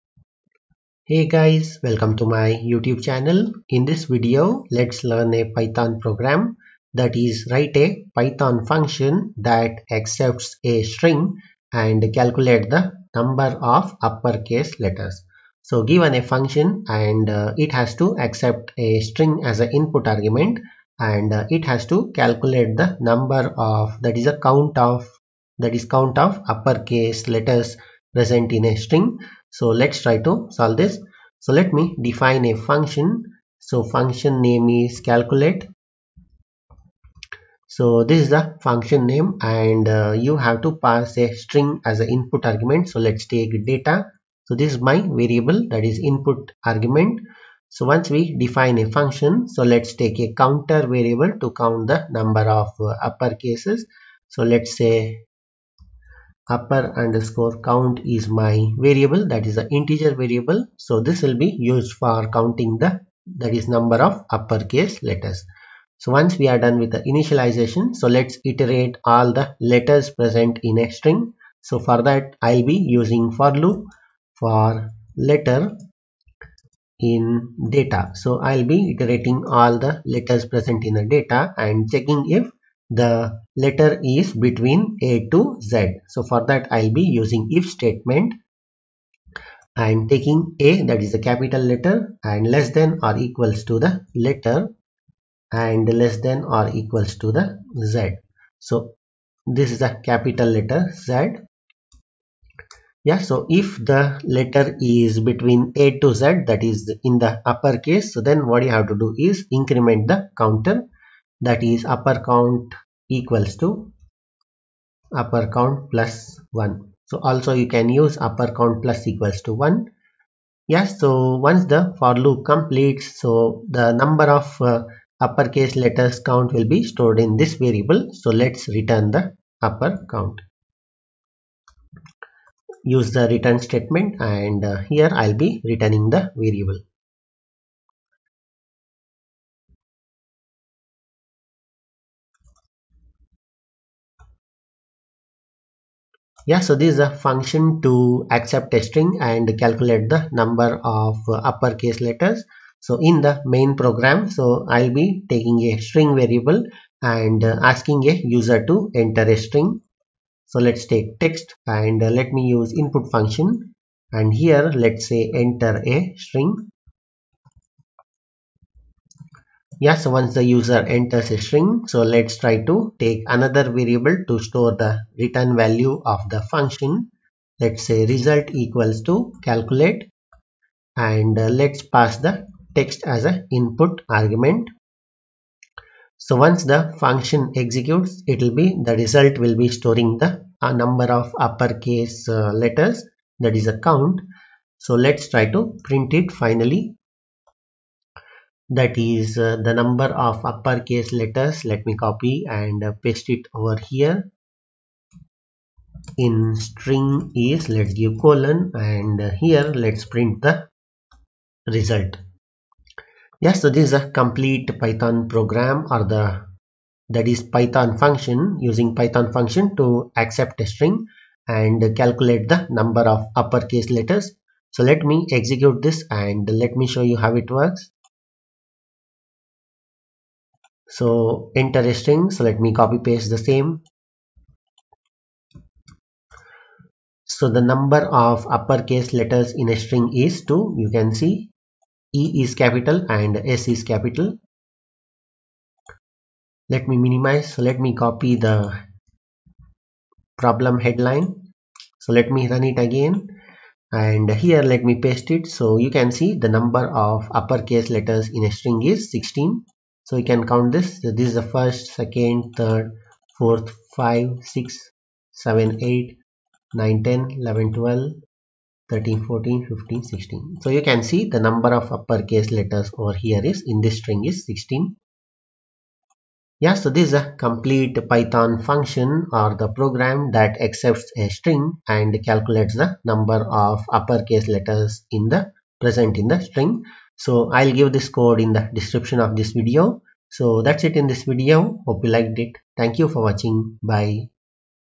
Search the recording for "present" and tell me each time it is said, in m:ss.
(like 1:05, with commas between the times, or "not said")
0:28, 1:10, 1:20, 4:45.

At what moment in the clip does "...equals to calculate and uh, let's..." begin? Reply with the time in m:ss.
2:58.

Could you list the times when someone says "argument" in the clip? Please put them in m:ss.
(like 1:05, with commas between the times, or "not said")
0:20, 0:42, 0:46, 3:04.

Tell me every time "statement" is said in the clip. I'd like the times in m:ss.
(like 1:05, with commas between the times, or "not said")
1:27, 2:13.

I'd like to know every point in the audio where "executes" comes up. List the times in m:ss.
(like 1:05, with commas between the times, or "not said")
3:07, 3:45.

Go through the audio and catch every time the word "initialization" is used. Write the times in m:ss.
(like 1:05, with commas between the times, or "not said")
1:07.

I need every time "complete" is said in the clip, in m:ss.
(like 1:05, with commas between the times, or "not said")
2:02, 3:34, 4:37.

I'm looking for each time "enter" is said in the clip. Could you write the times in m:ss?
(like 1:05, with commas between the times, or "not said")
2:38, 2:45, 2:50.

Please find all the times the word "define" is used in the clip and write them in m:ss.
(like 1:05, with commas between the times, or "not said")
0:32, 0:48.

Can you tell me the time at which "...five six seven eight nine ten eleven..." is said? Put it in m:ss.
4:23.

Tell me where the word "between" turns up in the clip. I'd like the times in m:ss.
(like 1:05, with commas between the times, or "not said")
1:24, 1:45.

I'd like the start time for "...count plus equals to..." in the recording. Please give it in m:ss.
1:58.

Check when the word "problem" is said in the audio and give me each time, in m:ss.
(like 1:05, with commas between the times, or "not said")
4:10.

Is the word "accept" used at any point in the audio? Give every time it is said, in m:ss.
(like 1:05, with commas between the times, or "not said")
0:09, 0:18, 2:28, 3:40, 4:40.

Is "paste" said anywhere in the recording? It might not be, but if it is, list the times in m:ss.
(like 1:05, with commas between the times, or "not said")
3:23, 3:53, 4:14.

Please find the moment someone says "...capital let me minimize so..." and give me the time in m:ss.
4:03.